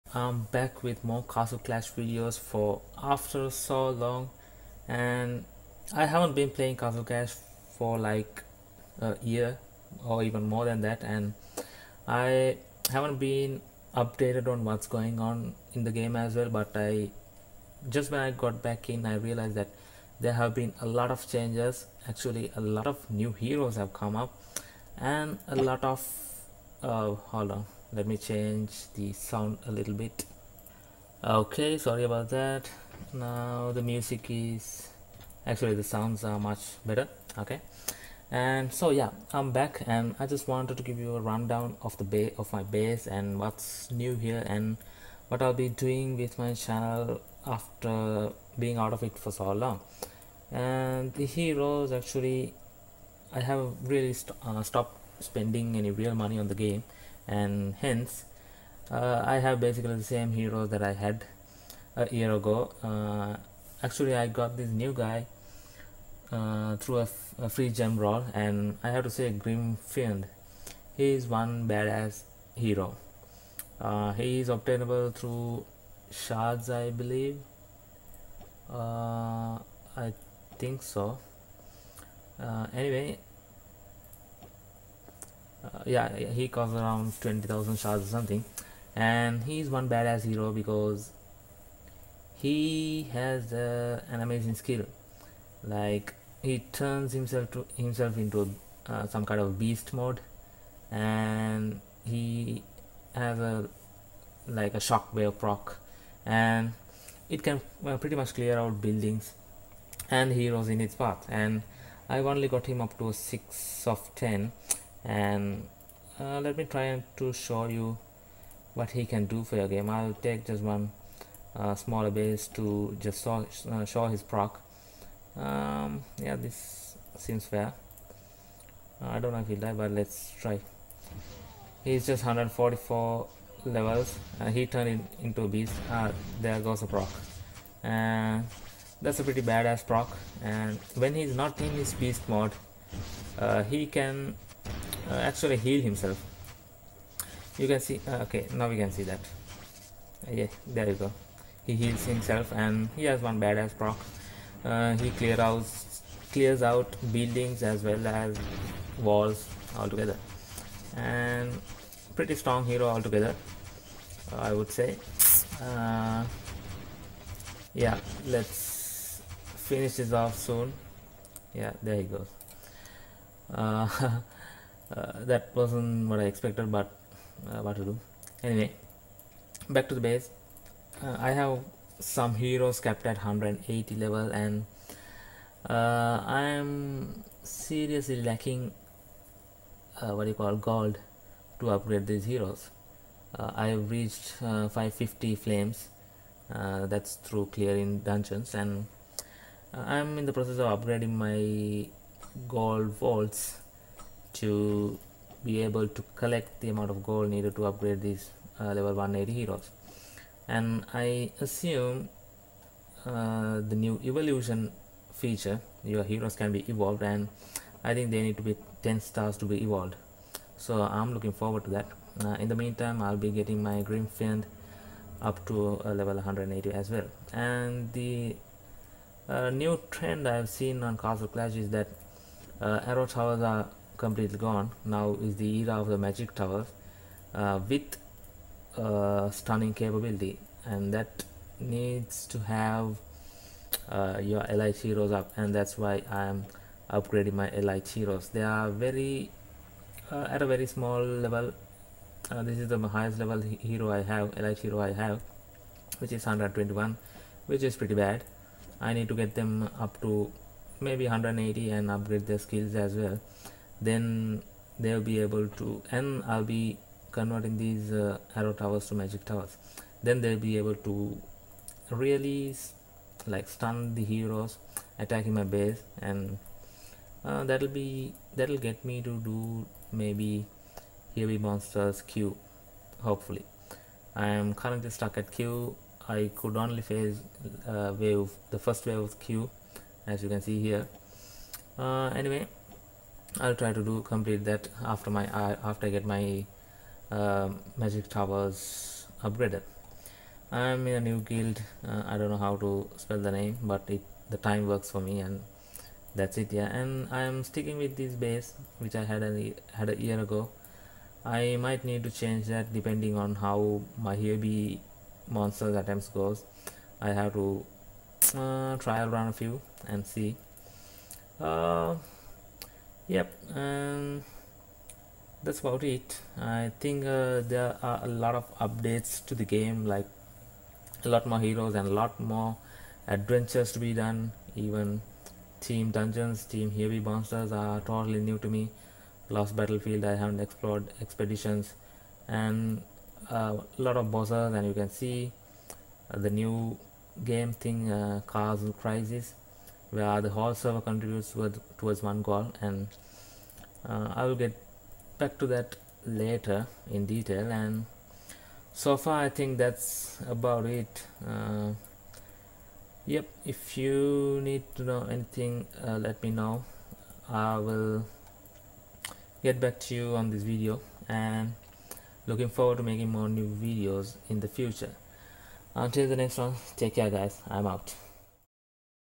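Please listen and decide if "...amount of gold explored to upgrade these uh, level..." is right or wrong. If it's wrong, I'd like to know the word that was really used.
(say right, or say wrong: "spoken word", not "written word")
wrong: "needed", not "explored".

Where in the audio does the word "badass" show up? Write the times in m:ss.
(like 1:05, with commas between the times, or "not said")
1:11, 1:29, 2:19, 2:33.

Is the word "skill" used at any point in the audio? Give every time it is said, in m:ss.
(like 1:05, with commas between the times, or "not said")
1:34, 4:22.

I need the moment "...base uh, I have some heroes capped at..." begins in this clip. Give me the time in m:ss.
3:00.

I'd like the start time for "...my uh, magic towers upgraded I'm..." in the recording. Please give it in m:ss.
4:56.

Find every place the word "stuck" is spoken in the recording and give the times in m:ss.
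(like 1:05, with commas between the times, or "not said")
4:44.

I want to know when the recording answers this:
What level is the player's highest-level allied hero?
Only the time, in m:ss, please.
4:16.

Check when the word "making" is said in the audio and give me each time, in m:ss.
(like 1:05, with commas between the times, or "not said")
6:12.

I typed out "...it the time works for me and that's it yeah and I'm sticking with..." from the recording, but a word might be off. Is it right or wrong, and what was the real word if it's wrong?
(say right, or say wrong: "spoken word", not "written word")
right.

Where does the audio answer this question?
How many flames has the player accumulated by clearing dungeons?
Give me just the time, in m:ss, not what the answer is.
3:14.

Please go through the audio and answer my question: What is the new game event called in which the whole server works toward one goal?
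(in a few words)
cars crisis.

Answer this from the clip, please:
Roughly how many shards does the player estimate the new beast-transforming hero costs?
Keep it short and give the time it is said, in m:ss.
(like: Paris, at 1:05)
20,000, at 1:27.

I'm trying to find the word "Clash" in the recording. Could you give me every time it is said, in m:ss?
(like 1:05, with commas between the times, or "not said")
0:01, 0:07, 3:51.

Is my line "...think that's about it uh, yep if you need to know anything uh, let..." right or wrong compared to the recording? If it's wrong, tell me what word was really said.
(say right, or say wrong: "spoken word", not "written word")
right.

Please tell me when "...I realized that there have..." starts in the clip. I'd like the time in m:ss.
0:19.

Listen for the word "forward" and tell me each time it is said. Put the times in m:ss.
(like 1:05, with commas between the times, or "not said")
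3:41, 6:12.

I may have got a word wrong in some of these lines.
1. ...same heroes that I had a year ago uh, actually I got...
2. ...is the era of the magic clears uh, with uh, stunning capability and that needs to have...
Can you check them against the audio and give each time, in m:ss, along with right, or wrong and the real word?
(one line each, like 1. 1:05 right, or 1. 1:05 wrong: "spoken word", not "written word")
1. 1:00 right
2. 3:55 wrong: "towers", not "clears".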